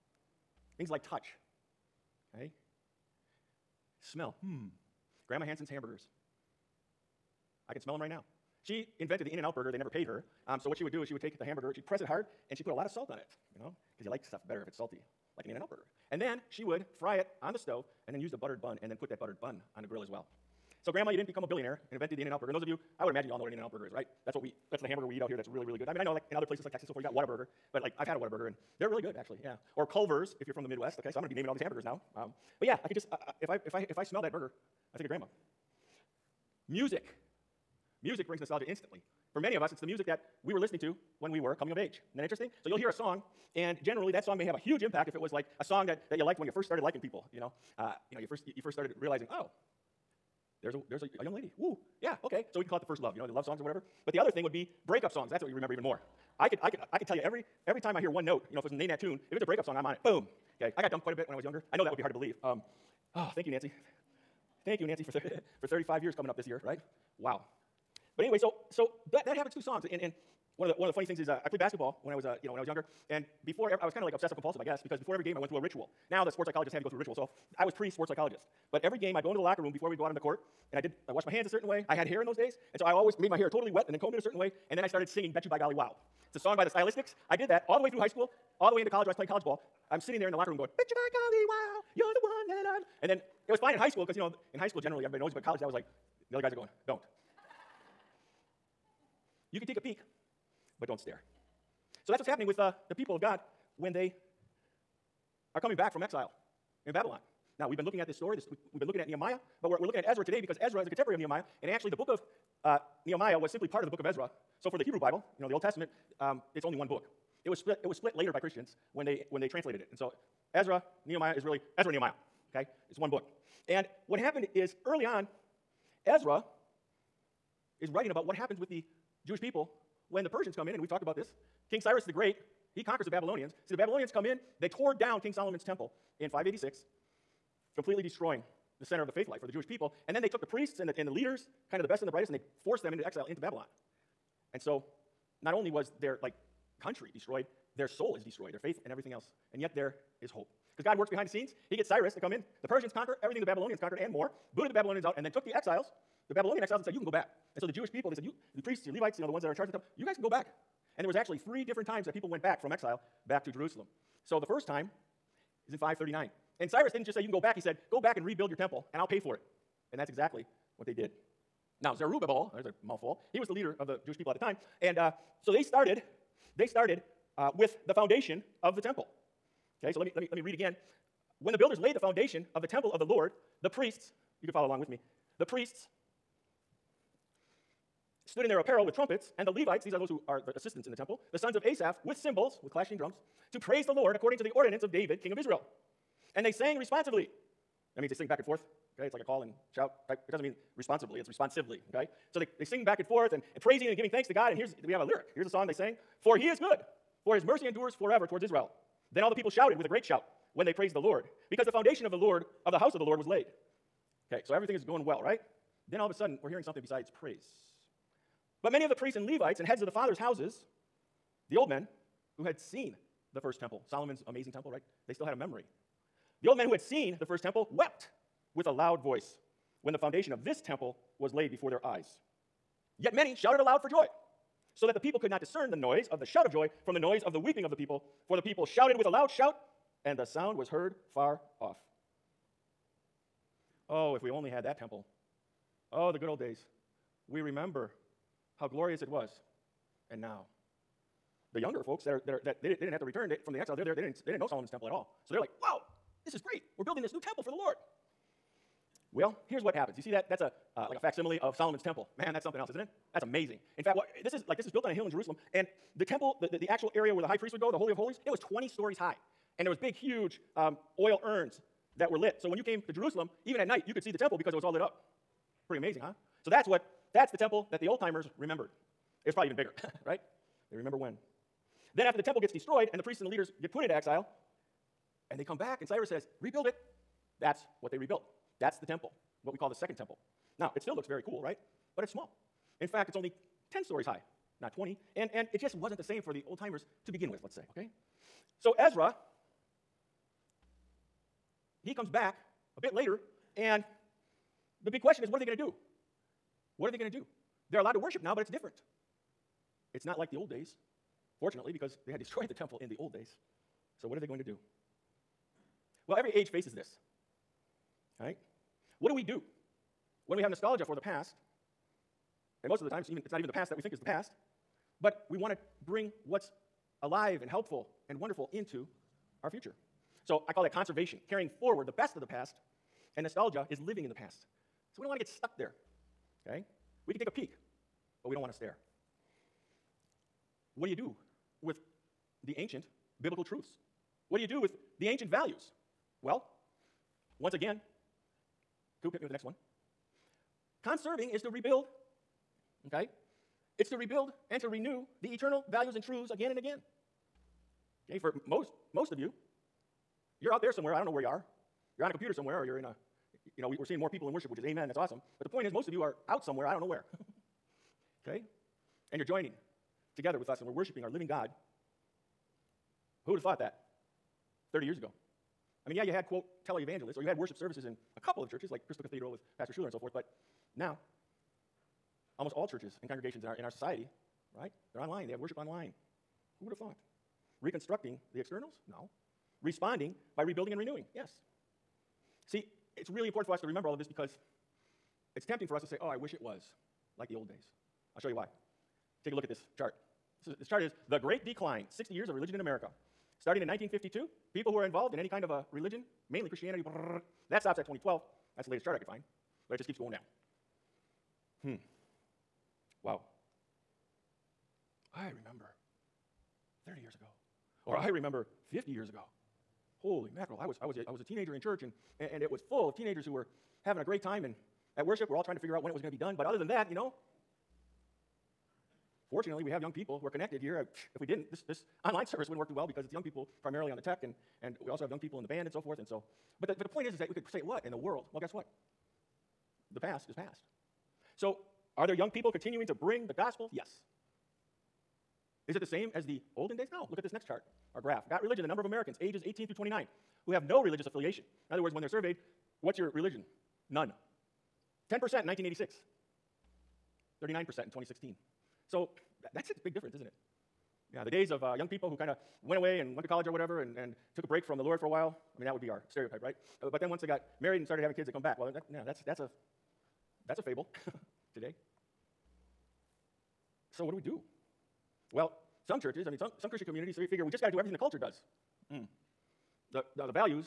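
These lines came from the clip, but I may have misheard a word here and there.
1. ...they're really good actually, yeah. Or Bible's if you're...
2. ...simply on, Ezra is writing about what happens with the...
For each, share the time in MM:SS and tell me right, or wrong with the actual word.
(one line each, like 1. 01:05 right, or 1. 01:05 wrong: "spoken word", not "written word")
1. 00:28 wrong: "Culver", not "Bible"
2. 02:04 wrong: "early", not "simply".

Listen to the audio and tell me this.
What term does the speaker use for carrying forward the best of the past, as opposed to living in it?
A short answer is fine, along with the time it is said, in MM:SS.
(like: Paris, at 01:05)
conservation, at 05:30.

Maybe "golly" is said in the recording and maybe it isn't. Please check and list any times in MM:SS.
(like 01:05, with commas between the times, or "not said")
01:25, 01:31.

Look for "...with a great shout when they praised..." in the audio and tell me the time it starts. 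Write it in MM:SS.
03:29.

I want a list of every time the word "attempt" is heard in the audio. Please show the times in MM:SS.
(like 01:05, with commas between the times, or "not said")
not said.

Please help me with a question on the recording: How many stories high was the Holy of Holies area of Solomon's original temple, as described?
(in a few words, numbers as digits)
20.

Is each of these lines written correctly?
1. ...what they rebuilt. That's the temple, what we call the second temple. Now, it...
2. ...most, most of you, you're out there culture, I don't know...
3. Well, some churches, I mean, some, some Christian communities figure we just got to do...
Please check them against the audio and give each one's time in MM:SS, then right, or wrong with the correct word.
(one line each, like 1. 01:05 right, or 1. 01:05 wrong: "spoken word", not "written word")
1. 04:47 right
2. 05:58 wrong: "somewhere", not "culture"
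3. 07:55 right.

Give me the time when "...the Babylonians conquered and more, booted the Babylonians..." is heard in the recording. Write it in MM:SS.
02:33.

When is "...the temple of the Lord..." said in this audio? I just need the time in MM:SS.
03:02.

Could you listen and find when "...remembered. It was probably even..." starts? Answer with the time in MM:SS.
04:38.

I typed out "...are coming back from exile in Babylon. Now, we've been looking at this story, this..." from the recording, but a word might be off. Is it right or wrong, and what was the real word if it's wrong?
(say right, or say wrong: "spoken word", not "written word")
right.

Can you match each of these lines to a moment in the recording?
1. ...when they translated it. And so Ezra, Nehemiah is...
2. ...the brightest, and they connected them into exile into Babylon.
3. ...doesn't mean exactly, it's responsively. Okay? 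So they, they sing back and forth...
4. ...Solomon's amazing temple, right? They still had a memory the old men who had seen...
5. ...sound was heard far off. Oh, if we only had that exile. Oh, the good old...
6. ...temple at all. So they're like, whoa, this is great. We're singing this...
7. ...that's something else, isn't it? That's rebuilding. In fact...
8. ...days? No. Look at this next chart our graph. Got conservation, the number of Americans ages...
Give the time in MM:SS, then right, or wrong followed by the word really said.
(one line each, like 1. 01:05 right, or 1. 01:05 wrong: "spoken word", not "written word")
1. 01:59 right
2. 02:22 wrong: "forced", not "connected"
3. 03:20 wrong: "responsibly", not "exactly"
4. 03:43 right
5. 04:00 wrong: "temple", not "exile"
6. 04:14 wrong: "building", not "singing"
7. 04:22 wrong: "amazing", not "rebuilding"
8. 07:26 wrong: "religion", not "conservation".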